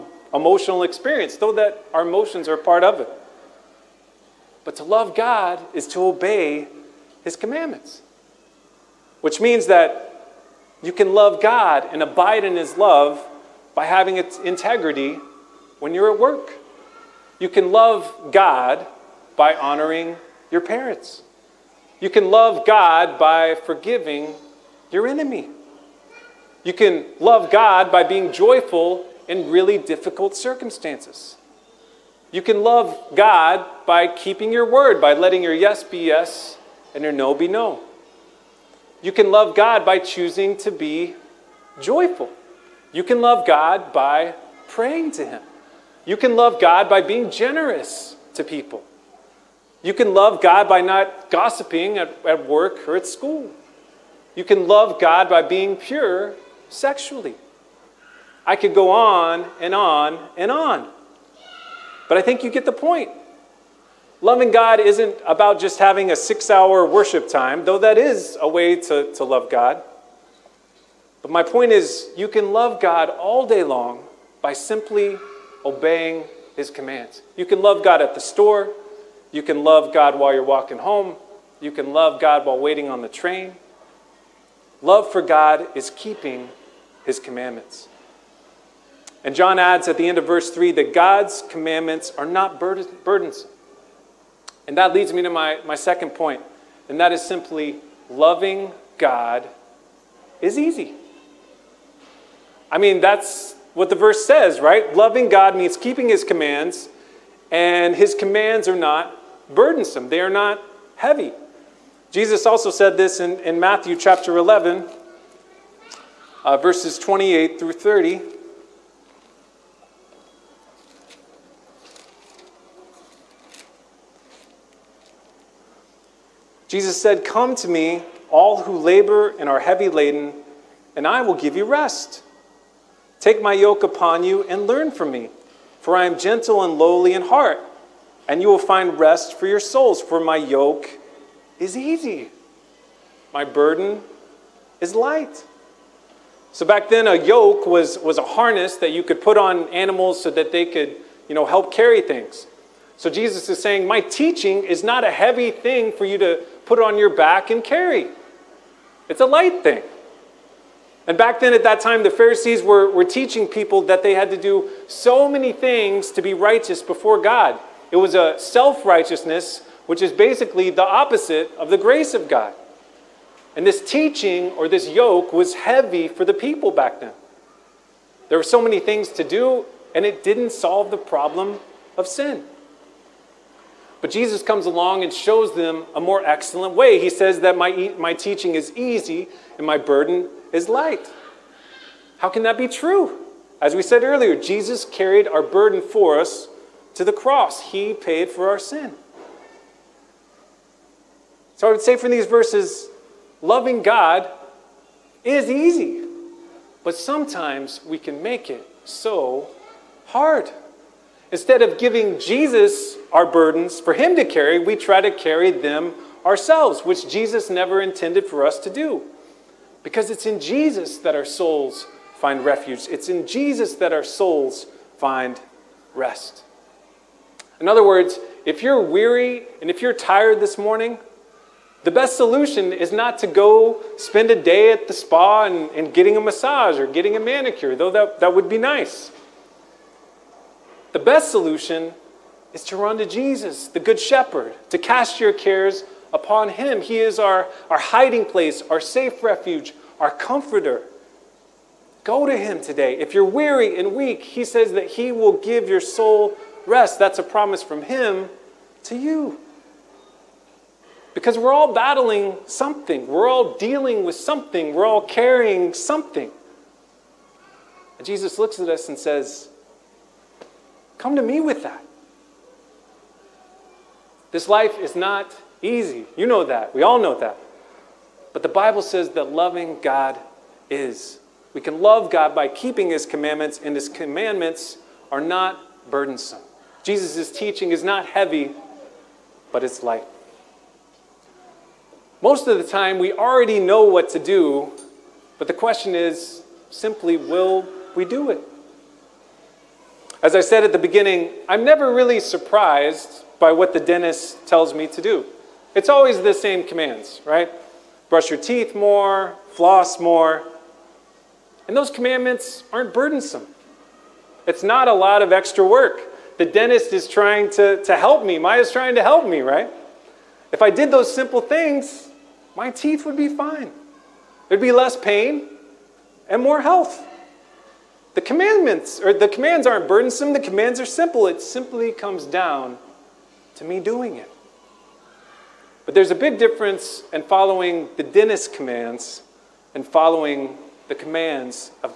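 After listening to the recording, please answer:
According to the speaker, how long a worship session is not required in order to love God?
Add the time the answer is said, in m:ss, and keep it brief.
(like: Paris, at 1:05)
6 hours, at 1:06.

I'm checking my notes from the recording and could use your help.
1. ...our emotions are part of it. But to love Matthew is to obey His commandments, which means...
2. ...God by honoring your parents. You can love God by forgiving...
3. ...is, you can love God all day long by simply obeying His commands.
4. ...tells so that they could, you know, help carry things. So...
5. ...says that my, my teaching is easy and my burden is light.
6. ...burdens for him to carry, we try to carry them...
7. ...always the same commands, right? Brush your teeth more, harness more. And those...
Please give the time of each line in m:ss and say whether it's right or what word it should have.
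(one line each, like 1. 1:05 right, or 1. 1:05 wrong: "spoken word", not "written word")
1. 0:01 wrong: "God", not "Matthew"
2. 0:18 right
3. 1:11 right
4. 2:29 wrong: "animals", not "tells"
5. 3:07 right
6. 3:33 right
7. 5:05 wrong: "floss", not "harness".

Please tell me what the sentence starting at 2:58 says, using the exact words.
There were so many things to do, and it didn't solve the problem of sin.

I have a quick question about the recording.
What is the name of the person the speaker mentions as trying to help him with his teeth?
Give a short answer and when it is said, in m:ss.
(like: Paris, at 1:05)
Maya, at 5:18.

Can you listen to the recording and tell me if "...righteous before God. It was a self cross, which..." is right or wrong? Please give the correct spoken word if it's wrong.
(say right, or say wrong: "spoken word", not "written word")
wrong: "righteousness", not "cross".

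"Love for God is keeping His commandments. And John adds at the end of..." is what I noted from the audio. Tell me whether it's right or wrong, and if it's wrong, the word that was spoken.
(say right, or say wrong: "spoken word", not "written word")
right.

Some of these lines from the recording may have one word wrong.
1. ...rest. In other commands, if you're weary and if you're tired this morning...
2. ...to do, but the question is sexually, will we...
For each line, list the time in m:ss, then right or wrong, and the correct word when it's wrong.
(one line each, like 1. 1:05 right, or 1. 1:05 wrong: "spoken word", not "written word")
1. 3:45 wrong: "words", not "commands"
2. 4:54 wrong: "simply", not "sexually".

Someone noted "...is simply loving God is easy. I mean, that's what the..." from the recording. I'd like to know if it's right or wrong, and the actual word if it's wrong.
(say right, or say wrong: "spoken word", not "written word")
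right.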